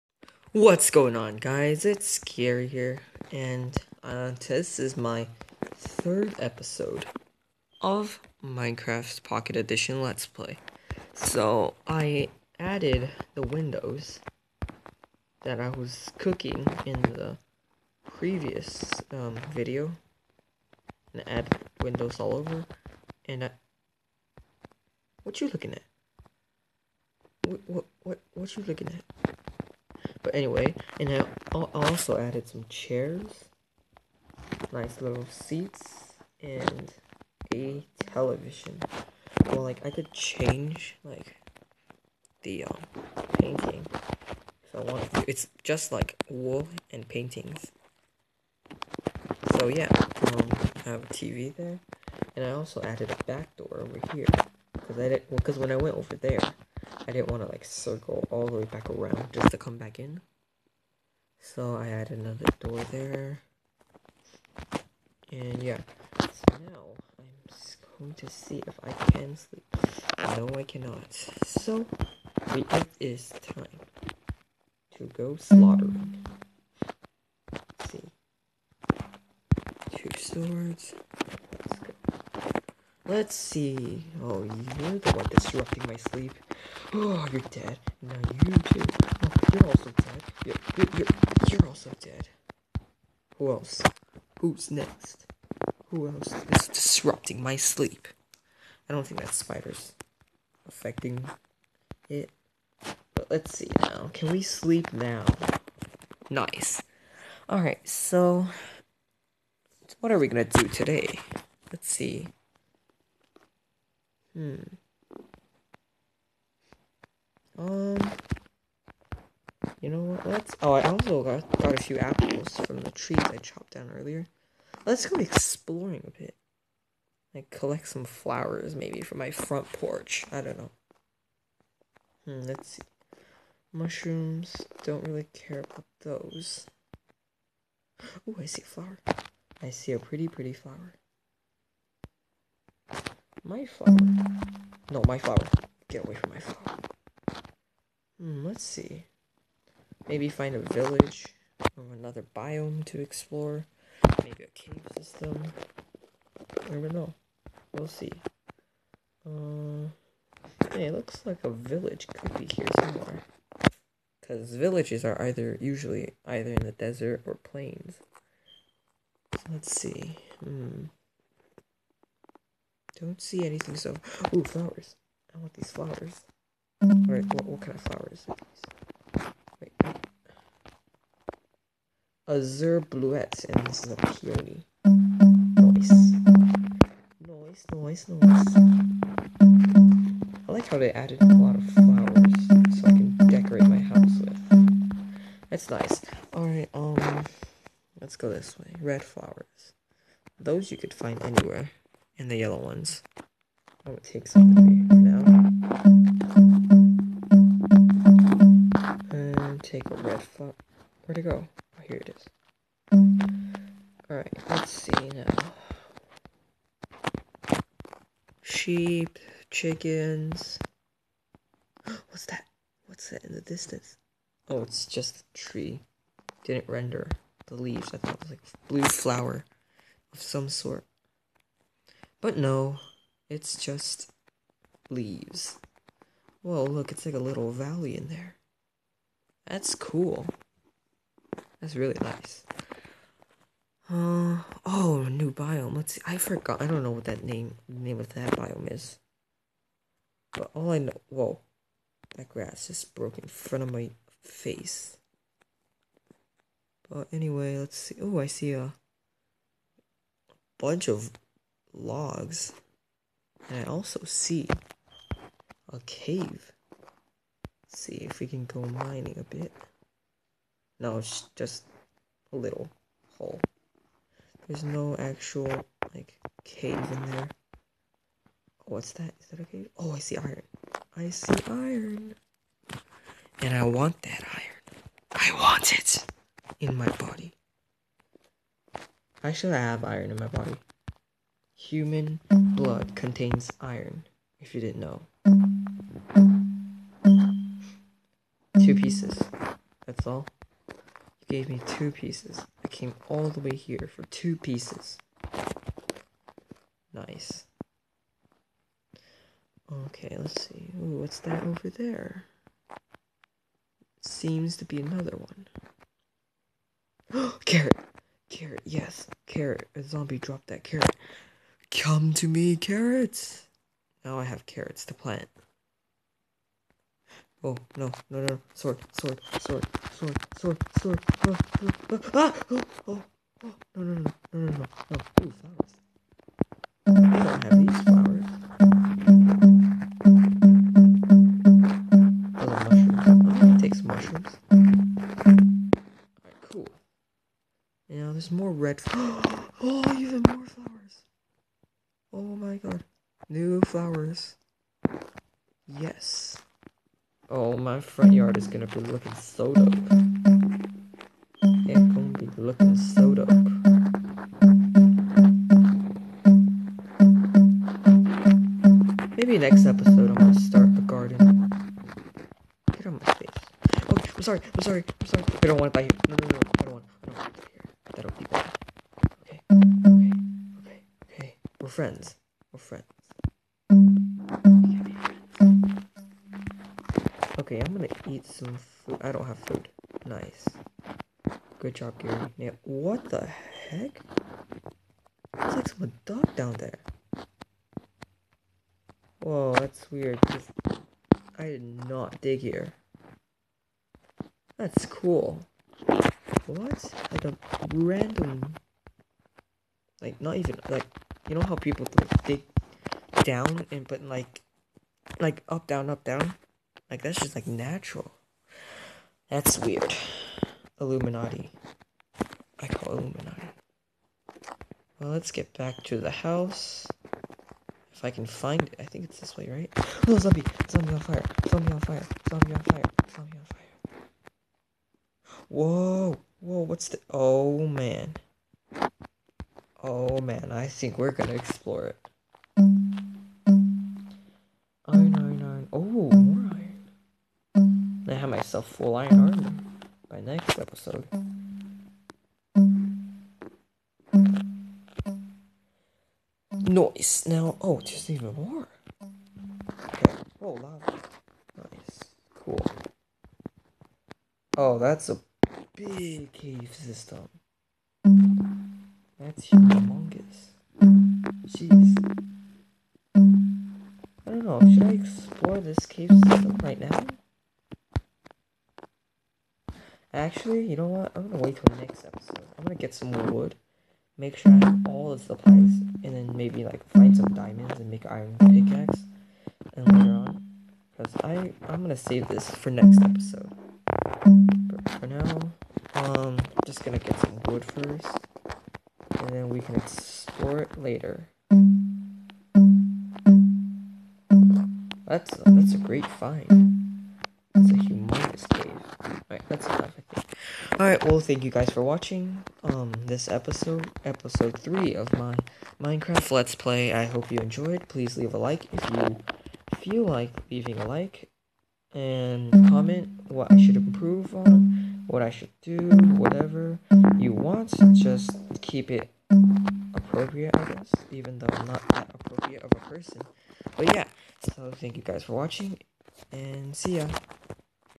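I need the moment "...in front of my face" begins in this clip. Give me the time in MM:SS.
04:13.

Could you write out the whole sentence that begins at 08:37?
Please leave a like if you feel like leaving a like.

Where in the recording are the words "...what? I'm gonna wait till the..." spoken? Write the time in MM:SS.
08:00.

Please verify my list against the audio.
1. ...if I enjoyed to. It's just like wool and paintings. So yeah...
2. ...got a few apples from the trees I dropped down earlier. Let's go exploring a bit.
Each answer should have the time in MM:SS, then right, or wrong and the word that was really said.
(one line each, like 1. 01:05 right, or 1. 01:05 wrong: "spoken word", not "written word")
1. 00:44 wrong: "wanted", not "enjoyed"
2. 02:01 wrong: "chopped", not "dropped".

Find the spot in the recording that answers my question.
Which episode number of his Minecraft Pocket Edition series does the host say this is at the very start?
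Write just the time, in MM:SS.
00:05.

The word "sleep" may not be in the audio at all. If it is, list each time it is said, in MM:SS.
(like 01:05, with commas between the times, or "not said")
01:09, 01:25, 01:37, 01:44.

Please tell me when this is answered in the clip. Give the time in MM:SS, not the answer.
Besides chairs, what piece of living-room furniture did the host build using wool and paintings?
00:38.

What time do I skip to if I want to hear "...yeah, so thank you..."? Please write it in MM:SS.
08:53.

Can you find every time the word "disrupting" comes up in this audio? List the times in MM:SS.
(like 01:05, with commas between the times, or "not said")
01:25, 01:36.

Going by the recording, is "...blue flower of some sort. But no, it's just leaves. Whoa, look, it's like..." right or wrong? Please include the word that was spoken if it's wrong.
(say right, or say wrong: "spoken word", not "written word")
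right.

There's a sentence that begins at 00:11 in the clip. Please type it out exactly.
So, I added the windows that I was cooking in the previous um, video, and I added windows all over, and I...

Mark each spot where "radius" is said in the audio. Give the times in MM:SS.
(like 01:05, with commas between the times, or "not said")
not said.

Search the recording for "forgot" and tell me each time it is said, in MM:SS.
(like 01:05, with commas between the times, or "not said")
04:06.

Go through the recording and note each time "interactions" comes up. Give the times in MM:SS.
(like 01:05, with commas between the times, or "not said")
not said.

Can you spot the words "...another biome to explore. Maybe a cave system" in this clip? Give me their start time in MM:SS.
02:31.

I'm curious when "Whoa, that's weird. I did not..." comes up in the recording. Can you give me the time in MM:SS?
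06:39.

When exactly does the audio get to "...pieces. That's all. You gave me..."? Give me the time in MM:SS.
04:58.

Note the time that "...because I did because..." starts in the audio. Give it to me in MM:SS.
00:54.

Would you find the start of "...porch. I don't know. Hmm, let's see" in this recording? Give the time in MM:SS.
02:09.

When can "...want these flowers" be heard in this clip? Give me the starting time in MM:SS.
02:55.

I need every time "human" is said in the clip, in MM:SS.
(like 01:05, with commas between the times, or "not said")
04:51.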